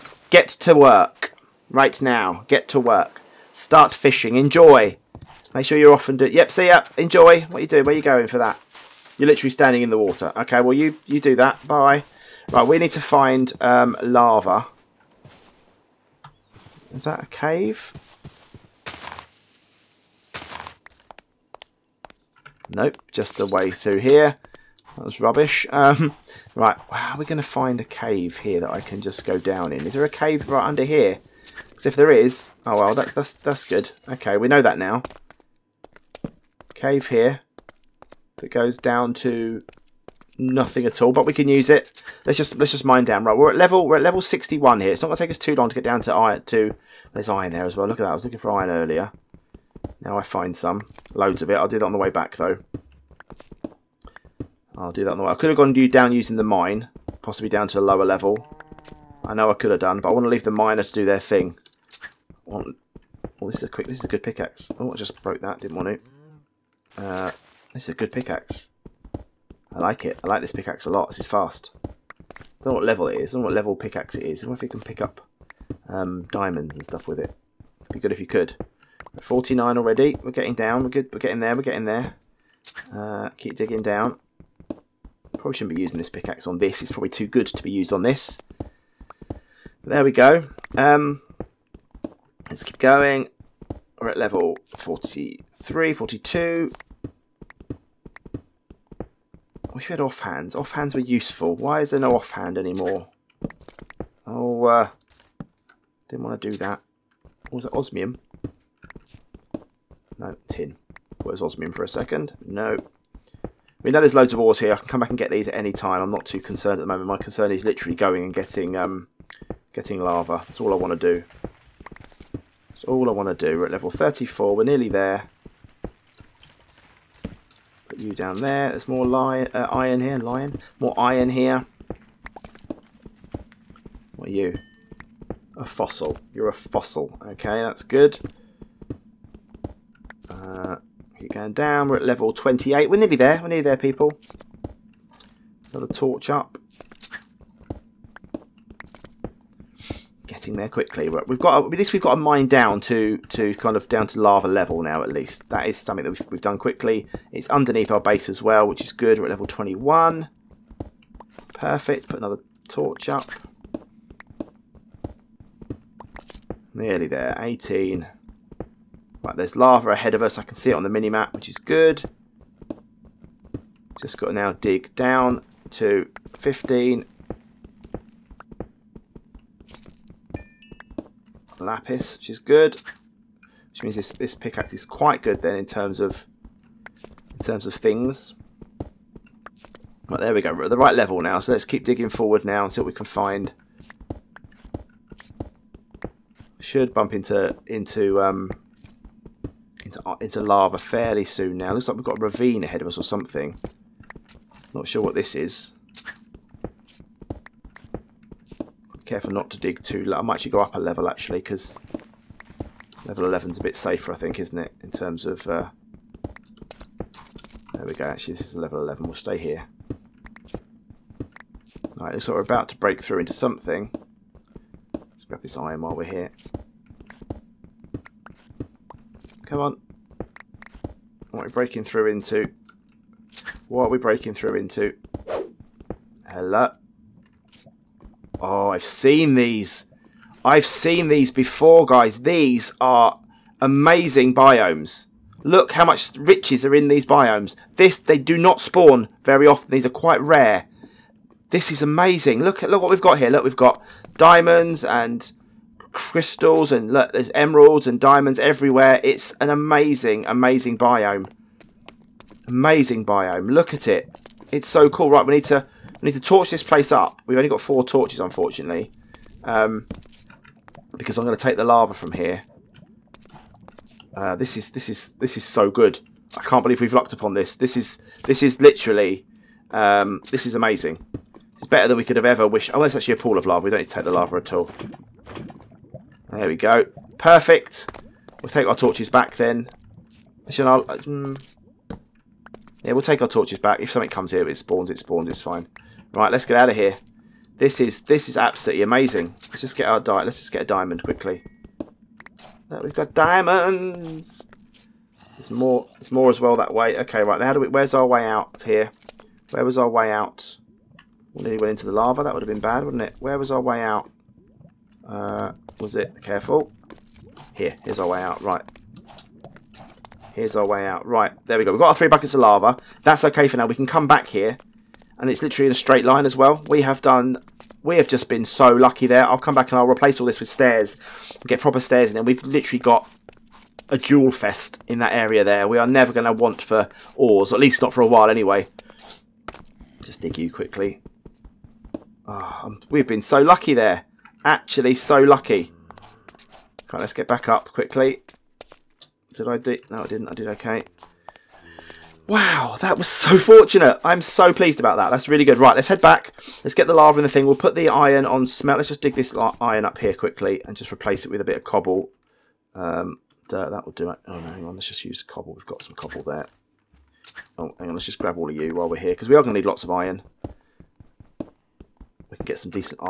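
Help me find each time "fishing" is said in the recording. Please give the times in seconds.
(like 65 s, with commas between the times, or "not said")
3 s.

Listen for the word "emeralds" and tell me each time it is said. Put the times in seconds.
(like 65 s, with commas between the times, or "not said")
257 s.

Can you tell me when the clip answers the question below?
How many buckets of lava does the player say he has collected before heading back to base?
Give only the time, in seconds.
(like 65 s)
321 s.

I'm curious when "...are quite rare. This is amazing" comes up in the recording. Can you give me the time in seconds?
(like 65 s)
249 s.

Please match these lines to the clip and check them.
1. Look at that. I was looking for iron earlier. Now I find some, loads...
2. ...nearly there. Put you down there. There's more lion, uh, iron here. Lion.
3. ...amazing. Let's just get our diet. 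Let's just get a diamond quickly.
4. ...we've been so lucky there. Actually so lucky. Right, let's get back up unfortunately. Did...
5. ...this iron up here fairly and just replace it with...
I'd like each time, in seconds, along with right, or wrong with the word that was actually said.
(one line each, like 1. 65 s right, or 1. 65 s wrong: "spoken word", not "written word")
1. 47 s right
2. 124 s right
3. 298 s right
4. 342 s wrong: "quickly", not "unfortunately"
5. 359 s wrong: "quickly", not "fairly".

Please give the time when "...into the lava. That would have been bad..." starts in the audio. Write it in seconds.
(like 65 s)
311 s.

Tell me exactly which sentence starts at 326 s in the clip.
We have done, we have just been so lucky there.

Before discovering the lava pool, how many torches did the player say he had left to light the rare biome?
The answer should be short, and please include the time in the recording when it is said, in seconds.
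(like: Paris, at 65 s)
4, at 267 s.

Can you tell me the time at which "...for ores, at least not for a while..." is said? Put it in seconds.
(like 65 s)
336 s.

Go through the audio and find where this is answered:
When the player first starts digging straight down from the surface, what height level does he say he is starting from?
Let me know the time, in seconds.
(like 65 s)
44 s.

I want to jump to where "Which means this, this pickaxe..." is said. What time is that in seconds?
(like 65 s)
183 s.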